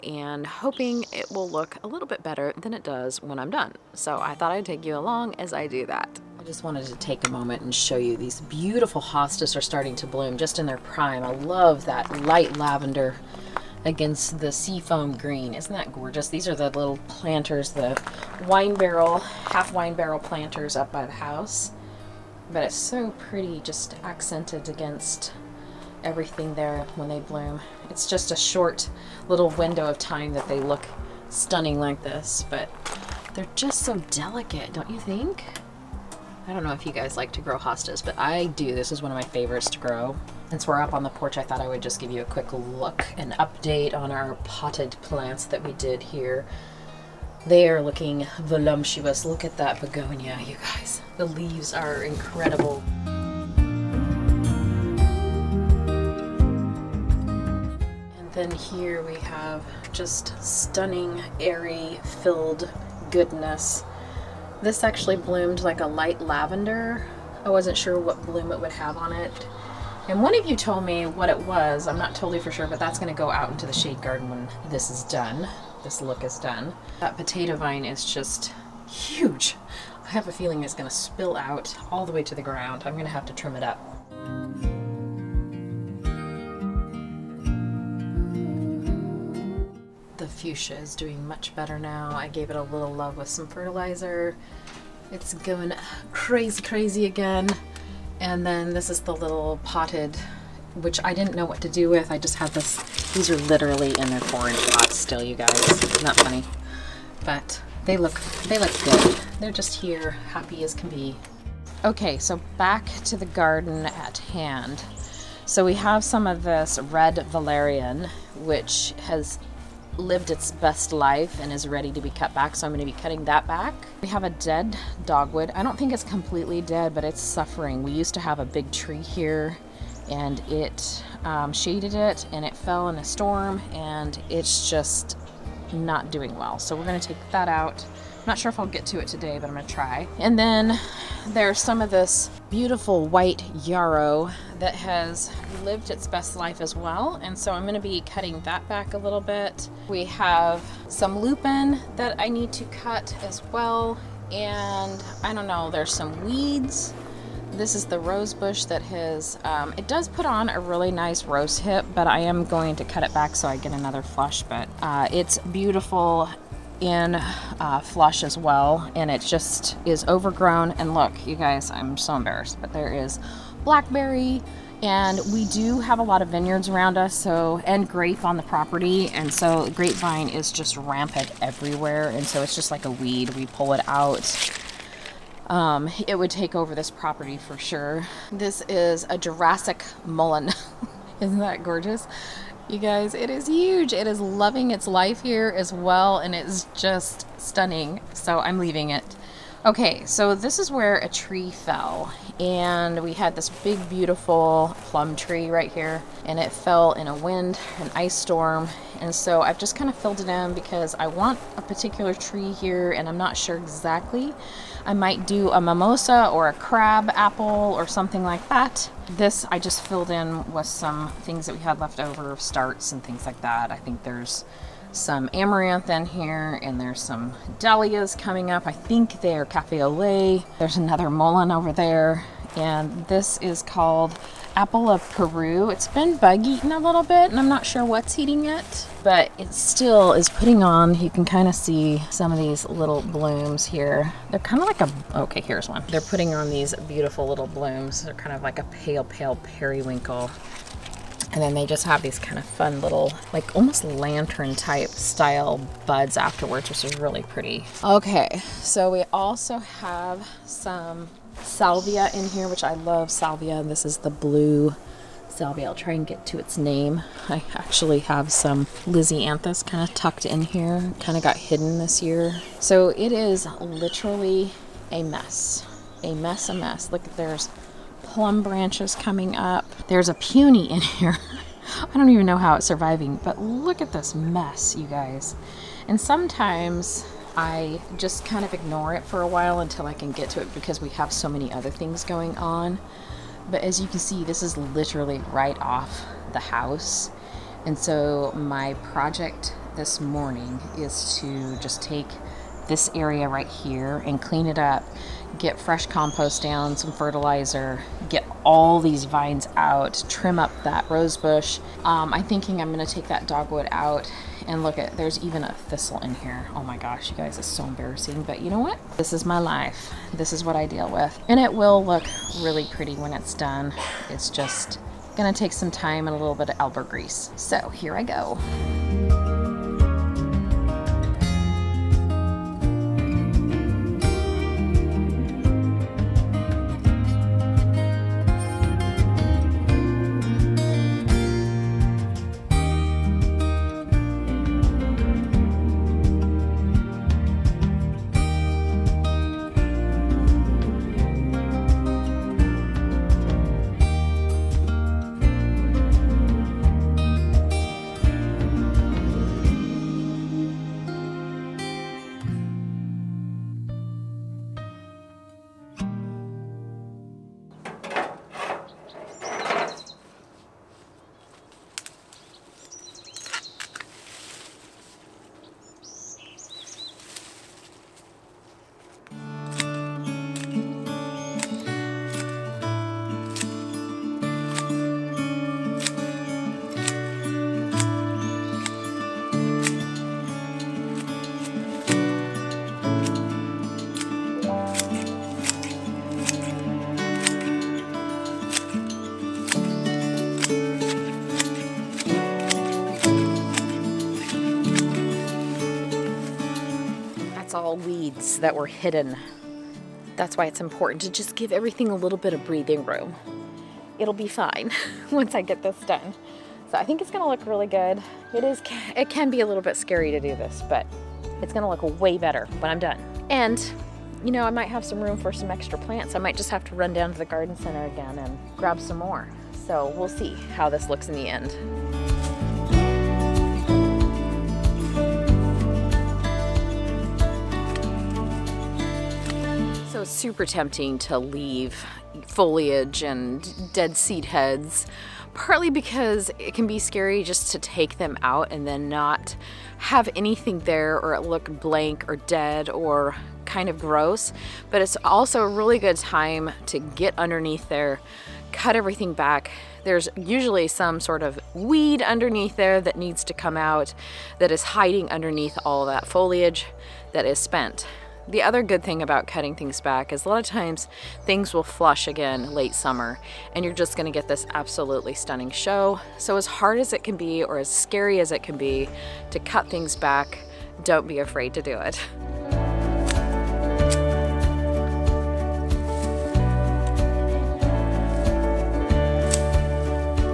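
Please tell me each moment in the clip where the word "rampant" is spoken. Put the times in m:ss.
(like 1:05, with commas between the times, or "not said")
3:00.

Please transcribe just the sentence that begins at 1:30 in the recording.
The fuchsia is doing much better now.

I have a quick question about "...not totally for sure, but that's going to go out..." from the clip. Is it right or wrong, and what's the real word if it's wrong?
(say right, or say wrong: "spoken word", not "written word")
right.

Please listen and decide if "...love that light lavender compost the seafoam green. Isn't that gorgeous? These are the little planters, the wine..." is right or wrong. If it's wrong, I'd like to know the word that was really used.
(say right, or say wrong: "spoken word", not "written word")
wrong: "against", not "compost".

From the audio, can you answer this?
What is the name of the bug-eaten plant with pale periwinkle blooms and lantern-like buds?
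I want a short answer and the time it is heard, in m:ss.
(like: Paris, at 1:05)
Apple of Peru, at 3:54.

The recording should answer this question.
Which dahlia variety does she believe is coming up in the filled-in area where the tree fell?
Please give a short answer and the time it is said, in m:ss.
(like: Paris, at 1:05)
Cafe au lait, at 3:49.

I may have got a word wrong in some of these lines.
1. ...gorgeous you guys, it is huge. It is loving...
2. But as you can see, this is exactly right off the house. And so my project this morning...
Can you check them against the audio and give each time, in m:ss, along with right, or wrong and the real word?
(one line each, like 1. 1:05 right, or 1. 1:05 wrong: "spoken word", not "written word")
1. 3:11 right
2. 4:53 wrong: "literally", not "exactly".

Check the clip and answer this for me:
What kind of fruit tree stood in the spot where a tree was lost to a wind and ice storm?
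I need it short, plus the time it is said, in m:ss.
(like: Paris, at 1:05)
Plum tree, at 3:24.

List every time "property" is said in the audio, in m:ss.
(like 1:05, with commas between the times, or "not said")
2:58, 3:06.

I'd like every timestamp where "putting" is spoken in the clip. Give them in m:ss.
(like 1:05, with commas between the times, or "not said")
4:00, 4:06.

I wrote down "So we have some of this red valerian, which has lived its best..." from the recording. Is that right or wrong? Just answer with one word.
right.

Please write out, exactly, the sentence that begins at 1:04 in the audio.
This actually bloomed like a light lavender.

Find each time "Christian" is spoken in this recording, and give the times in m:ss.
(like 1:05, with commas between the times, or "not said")
not said.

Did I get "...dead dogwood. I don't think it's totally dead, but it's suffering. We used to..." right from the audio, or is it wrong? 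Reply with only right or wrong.
wrong.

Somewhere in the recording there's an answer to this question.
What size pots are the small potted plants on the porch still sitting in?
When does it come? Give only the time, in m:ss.
1:44.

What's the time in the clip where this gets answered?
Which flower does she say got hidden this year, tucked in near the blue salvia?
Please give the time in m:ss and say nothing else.
4:28.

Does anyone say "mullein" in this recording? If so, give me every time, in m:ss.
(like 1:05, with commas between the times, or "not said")
3:10, 3:51.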